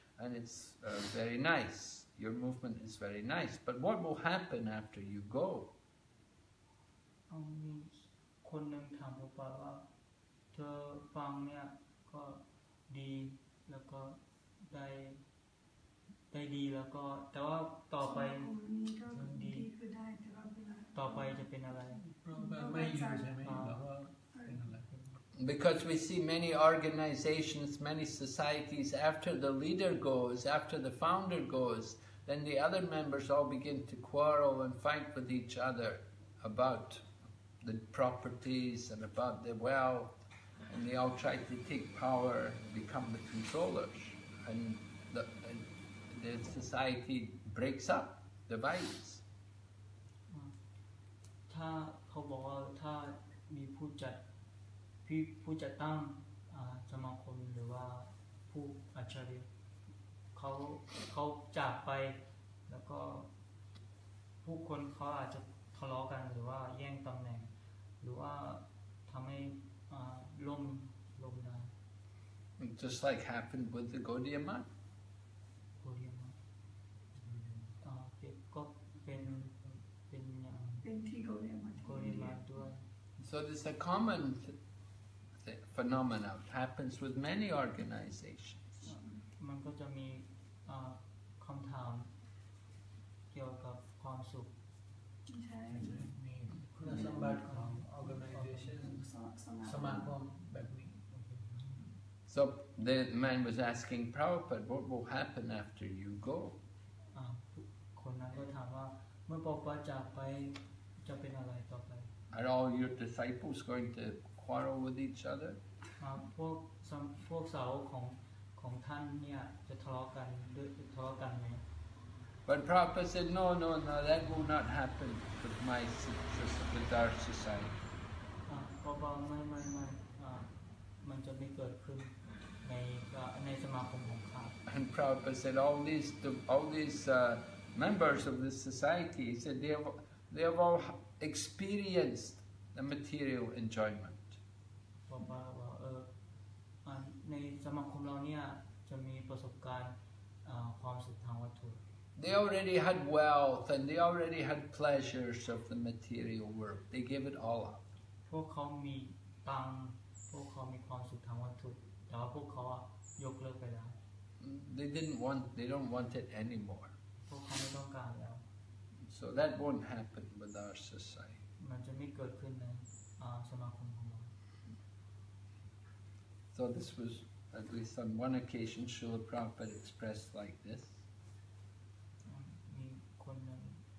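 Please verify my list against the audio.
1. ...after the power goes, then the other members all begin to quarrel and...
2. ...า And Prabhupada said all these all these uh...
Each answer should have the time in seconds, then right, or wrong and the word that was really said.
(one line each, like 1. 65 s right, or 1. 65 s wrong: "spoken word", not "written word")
1. 30 s wrong: "founder", not "power"
2. 134 s right.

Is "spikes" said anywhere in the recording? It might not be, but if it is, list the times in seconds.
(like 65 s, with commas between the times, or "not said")
not said.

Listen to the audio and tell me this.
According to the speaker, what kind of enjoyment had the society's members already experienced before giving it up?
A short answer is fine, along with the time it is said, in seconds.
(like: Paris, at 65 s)
material enjoyment, at 142 s.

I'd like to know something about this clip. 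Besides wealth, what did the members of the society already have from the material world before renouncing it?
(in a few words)
pleasures.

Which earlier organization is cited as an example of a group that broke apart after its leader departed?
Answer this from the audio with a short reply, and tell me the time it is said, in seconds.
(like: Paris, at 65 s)
Gaudiya, at 74 s.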